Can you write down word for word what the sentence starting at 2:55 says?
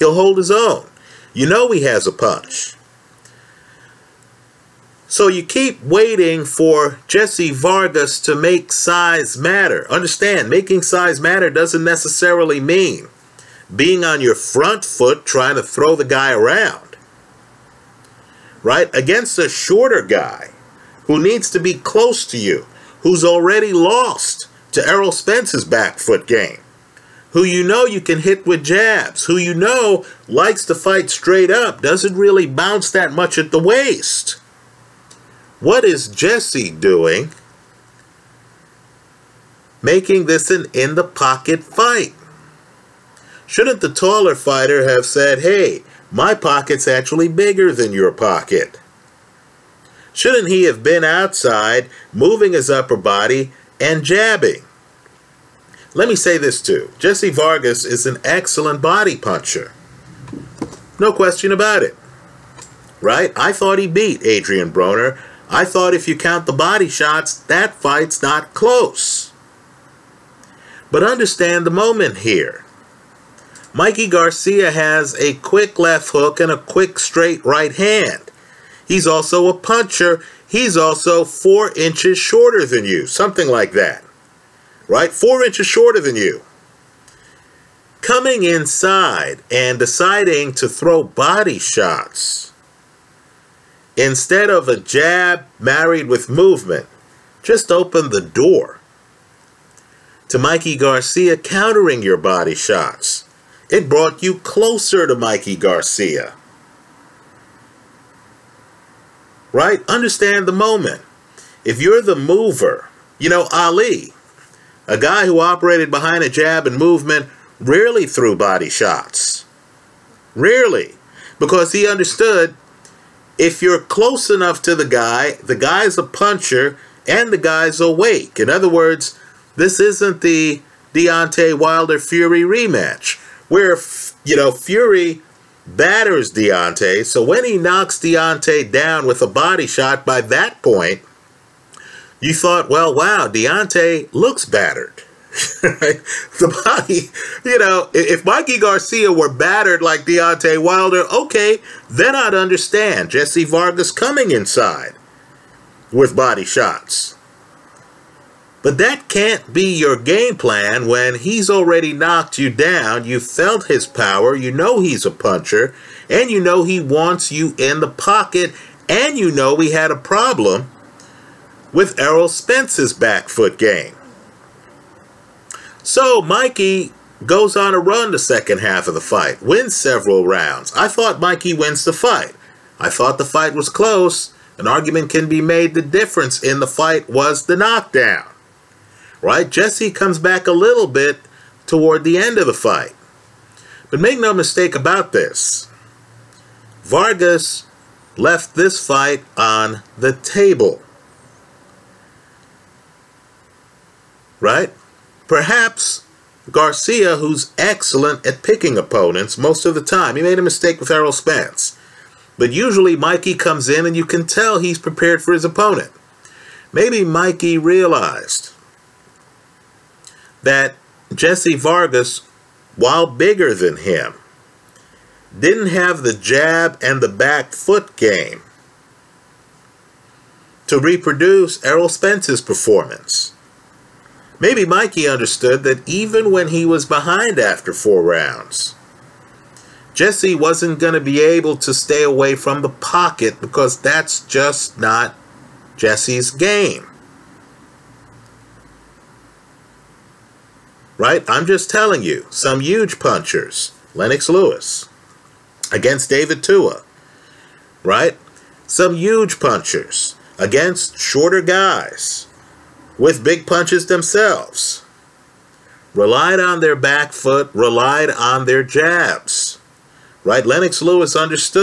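So Mikey goes on a run the second half of the fight, wins several rounds.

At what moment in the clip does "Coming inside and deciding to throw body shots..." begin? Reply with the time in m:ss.
1:28.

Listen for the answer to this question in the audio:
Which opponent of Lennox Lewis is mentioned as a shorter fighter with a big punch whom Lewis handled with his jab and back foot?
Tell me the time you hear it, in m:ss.
4:16.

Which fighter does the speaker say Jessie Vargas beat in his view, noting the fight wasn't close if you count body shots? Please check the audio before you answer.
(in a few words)
Adrian Broner.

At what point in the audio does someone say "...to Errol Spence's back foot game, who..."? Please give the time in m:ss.
0:24.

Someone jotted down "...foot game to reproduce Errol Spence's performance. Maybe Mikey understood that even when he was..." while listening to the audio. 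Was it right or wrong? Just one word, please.
right.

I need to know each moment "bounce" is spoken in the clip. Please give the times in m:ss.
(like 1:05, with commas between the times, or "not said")
0:32.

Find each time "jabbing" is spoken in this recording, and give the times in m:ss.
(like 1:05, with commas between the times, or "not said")
0:54.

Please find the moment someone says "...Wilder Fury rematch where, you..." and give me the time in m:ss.
2:11.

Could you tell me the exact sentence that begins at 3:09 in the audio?
Jessie comes back a little bit toward the end of the fight.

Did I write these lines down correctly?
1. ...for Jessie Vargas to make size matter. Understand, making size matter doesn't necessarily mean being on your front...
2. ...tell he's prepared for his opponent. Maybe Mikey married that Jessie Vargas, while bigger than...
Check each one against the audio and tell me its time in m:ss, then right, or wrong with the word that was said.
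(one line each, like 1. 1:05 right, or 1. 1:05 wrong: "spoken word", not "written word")
1. 0:06 right
2. 3:34 wrong: "realized", not "married".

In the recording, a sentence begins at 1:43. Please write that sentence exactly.
It brought you closer to Mikey Garcia.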